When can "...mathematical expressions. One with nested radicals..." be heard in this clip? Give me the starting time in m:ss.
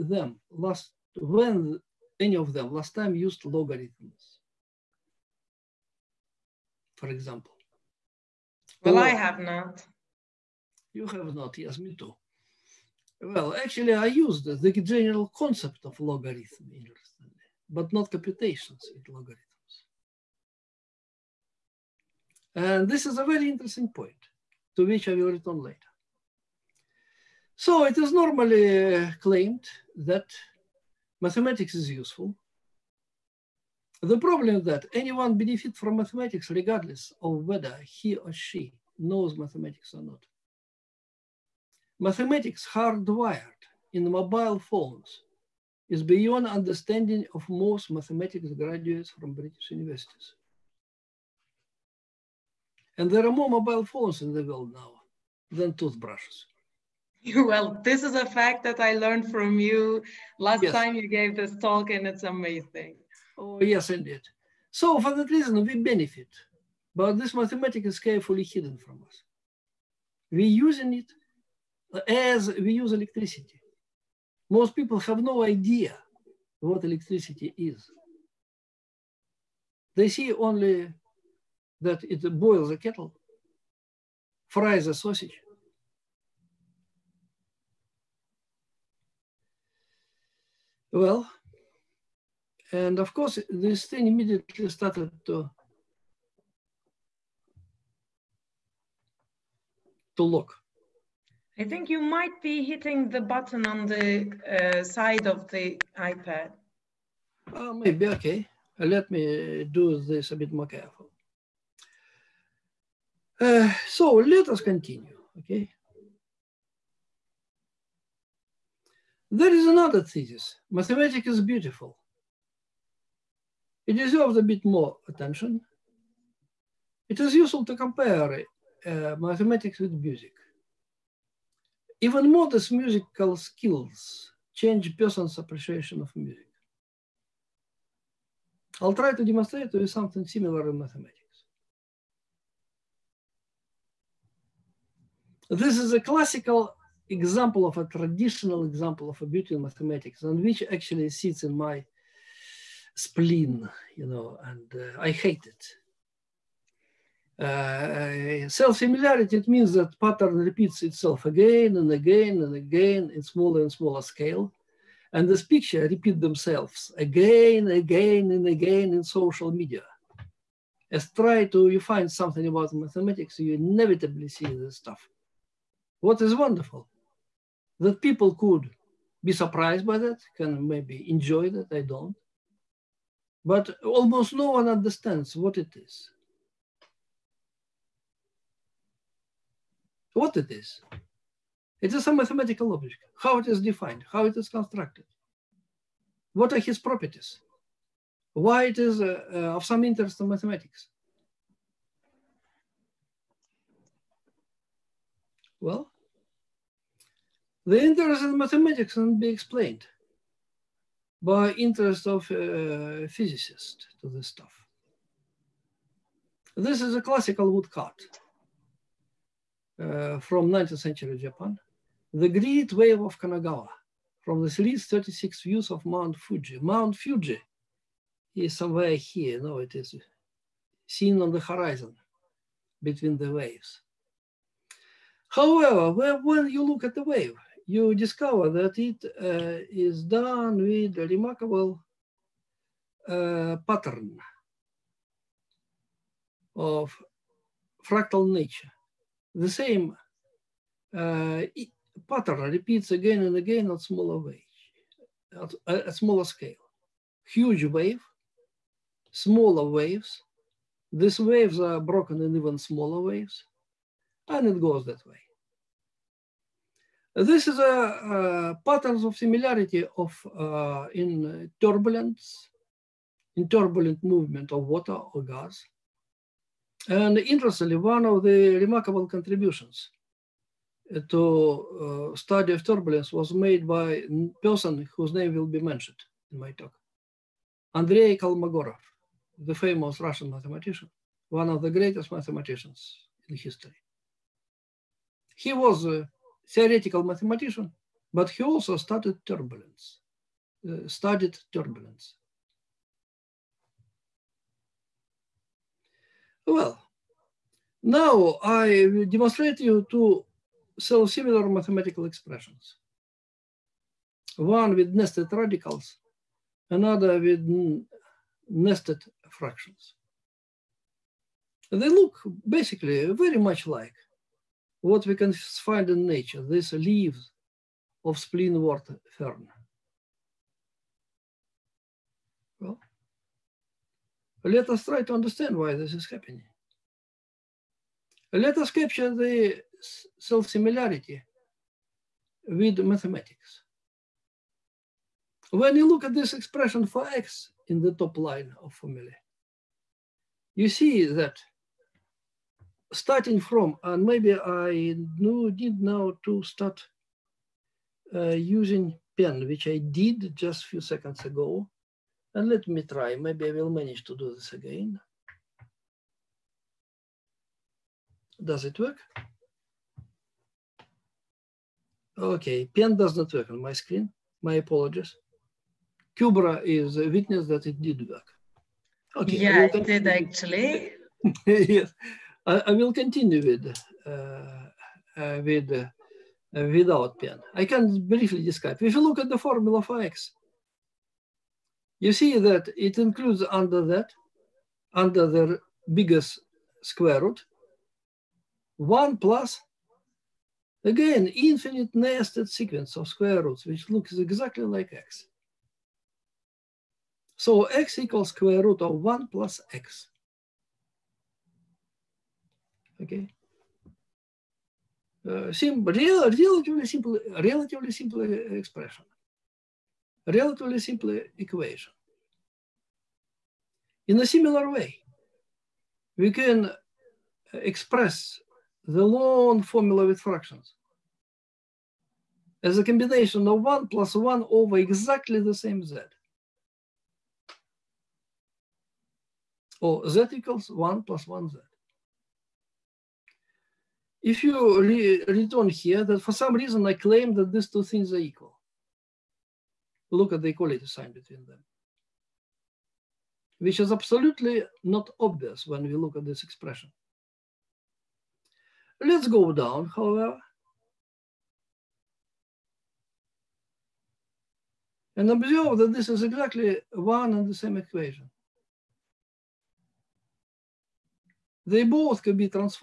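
5:11.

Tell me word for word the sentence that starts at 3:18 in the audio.
Why it is uh, uh, of some interest in mathematics?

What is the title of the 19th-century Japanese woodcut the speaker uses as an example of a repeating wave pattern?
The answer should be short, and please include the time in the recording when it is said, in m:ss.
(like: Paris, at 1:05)
The Great Wave of Kanagawa, at 3:42.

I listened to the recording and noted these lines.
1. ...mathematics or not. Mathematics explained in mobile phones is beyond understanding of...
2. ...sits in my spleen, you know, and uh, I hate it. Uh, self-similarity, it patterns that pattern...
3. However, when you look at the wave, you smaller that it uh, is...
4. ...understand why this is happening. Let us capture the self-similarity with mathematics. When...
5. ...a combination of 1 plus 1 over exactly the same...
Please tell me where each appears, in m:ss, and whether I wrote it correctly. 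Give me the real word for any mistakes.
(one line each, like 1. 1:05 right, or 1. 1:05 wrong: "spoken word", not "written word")
1. 0:39 wrong: "hardwired", not "explained"
2. 2:31 wrong: "means", not "patterns"
3. 3:55 wrong: "discover", not "smaller"
4. 5:35 right
5. 7:12 right.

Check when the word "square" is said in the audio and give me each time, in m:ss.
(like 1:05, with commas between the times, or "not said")
6:36, 6:43, 6:48.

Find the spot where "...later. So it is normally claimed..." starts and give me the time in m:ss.
0:25.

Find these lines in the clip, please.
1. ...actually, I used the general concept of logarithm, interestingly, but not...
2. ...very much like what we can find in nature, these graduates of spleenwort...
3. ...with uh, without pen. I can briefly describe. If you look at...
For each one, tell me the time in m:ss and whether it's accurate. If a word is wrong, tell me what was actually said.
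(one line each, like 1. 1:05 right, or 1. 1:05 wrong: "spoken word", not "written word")
1. 0:13 right
2. 5:23 wrong: "leaves", not "graduates"
3. 6:25 right.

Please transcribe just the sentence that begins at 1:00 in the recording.
time you gave this talk, and it's amazing.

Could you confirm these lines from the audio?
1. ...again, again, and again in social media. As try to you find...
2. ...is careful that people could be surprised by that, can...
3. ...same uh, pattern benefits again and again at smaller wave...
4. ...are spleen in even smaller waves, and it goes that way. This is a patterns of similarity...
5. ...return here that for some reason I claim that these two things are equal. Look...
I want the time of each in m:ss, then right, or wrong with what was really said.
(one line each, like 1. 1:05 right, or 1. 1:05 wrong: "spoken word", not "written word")
1. 2:46 right
2. 2:56 wrong: "wonderful", not "careful"
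3. 4:09 wrong: "repeats", not "benefits"
4. 4:21 wrong: "broken", not "spleen"
5. 7:25 right.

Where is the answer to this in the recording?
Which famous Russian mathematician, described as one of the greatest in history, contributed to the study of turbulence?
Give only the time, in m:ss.
4:47.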